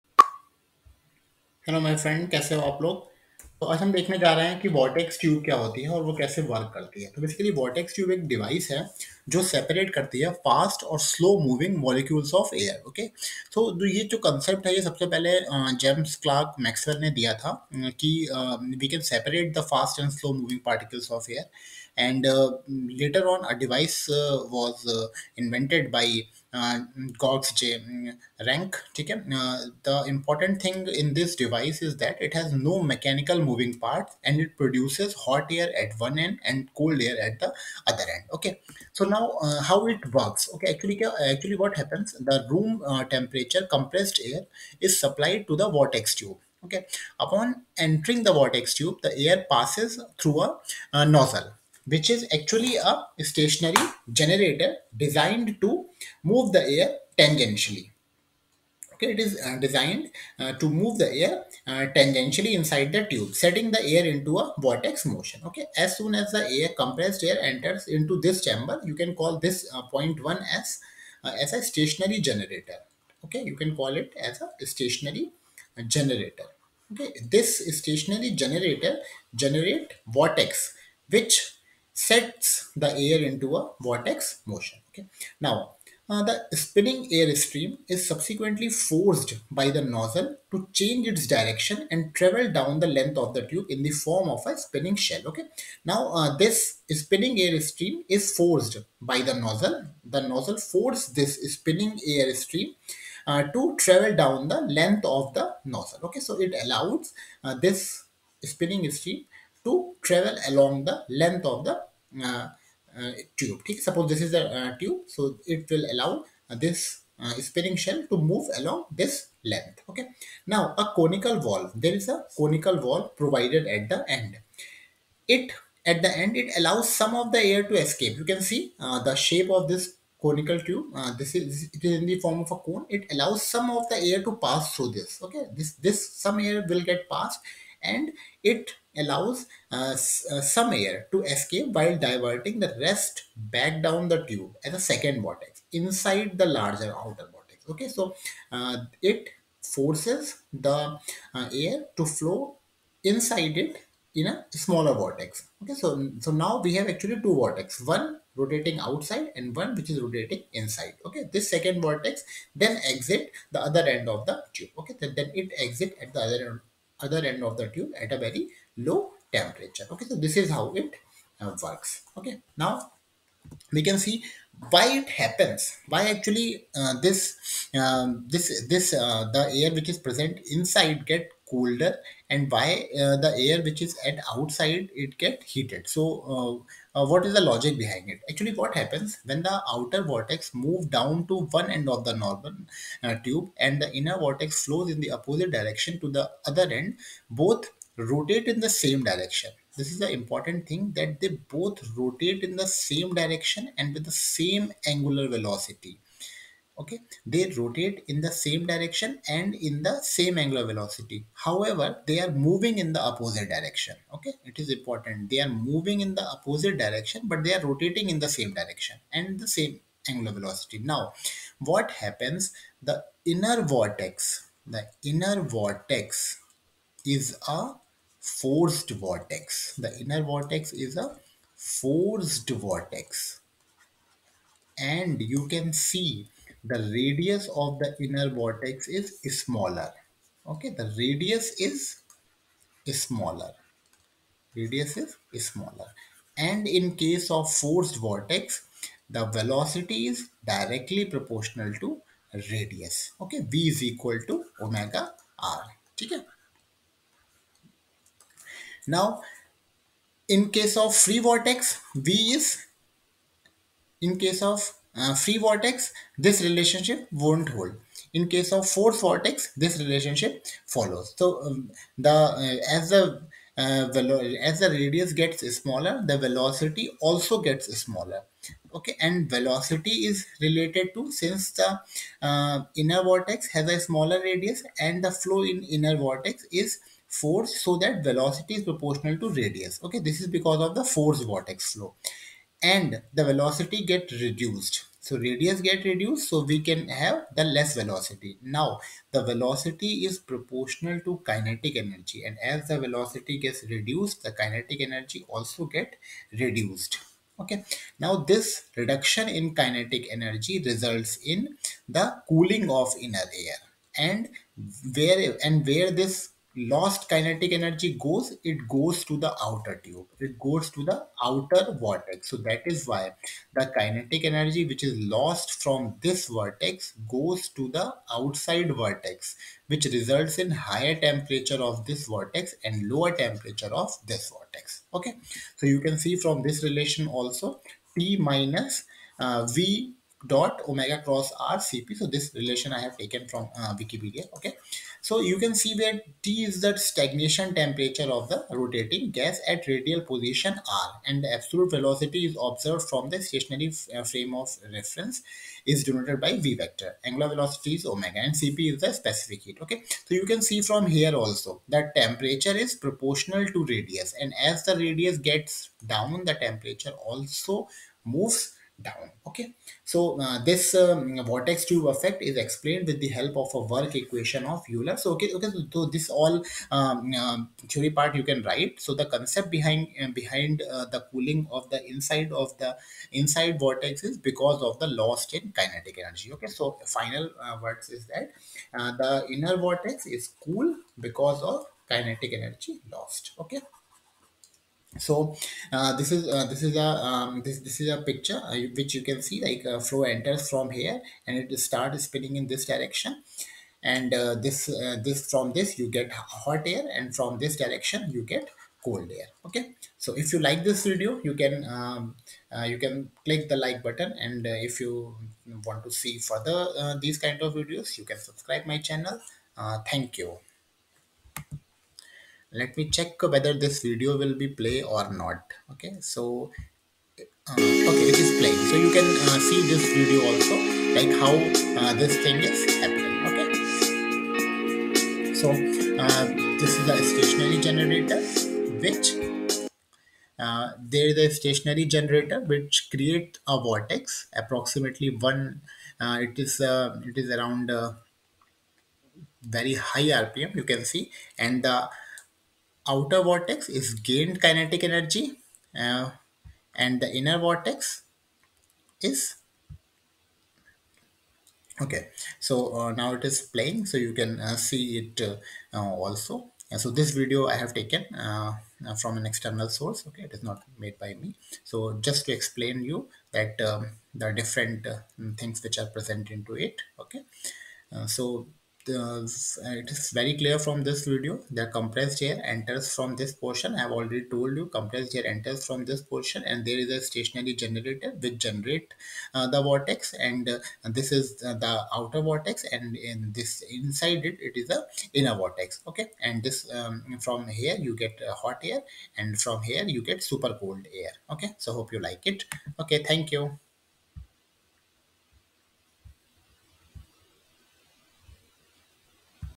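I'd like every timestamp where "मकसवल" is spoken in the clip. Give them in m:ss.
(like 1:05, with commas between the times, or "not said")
0:16.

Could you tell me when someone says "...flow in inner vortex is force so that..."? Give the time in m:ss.
4:45.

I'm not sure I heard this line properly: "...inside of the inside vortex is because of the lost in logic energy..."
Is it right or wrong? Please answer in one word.
wrong.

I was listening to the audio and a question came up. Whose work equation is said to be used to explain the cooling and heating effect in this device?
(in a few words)
Euler.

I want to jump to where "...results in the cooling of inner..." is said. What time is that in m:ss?
5:10.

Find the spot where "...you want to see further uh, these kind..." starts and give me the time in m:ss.
6:54.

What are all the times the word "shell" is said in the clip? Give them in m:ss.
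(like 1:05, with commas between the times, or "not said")
1:35, 1:57.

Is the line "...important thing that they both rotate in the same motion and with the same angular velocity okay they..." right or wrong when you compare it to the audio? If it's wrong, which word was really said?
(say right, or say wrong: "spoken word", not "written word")
wrong: "direction", not "motion".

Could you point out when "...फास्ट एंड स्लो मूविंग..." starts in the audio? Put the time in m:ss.
0:19.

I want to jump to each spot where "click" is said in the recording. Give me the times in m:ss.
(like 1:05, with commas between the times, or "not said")
6:53.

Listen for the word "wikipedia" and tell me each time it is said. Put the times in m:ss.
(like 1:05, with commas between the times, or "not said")
5:43.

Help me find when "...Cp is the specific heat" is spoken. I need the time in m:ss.
5:58.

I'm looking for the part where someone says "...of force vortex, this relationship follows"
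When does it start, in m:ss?
4:28.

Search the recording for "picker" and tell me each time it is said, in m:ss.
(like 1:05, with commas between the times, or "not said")
not said.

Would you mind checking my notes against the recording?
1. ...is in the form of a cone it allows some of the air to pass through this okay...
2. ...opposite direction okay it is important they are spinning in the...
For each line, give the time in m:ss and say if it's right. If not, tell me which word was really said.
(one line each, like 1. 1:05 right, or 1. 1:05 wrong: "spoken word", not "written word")
1. 2:11 right
2. 3:33 wrong: "moving", not "spinning".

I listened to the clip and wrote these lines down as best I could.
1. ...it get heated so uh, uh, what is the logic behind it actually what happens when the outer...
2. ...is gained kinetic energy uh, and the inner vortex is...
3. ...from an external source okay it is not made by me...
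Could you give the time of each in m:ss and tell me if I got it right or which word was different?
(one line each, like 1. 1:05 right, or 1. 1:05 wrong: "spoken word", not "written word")
1. 3:05 right
2. 7:33 right
3. 7:48 right.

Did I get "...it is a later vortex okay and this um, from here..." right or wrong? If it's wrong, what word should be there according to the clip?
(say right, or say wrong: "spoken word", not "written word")
wrong: "inner", not "later".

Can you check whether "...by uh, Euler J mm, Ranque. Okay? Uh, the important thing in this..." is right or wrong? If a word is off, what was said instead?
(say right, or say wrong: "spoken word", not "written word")
wrong: "Georges", not "Euler".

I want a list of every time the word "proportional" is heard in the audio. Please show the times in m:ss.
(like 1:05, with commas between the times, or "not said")
4:11, 4:48, 5:00, 6:02.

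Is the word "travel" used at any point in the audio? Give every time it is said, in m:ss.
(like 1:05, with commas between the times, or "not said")
1:32, 1:43, 1:50.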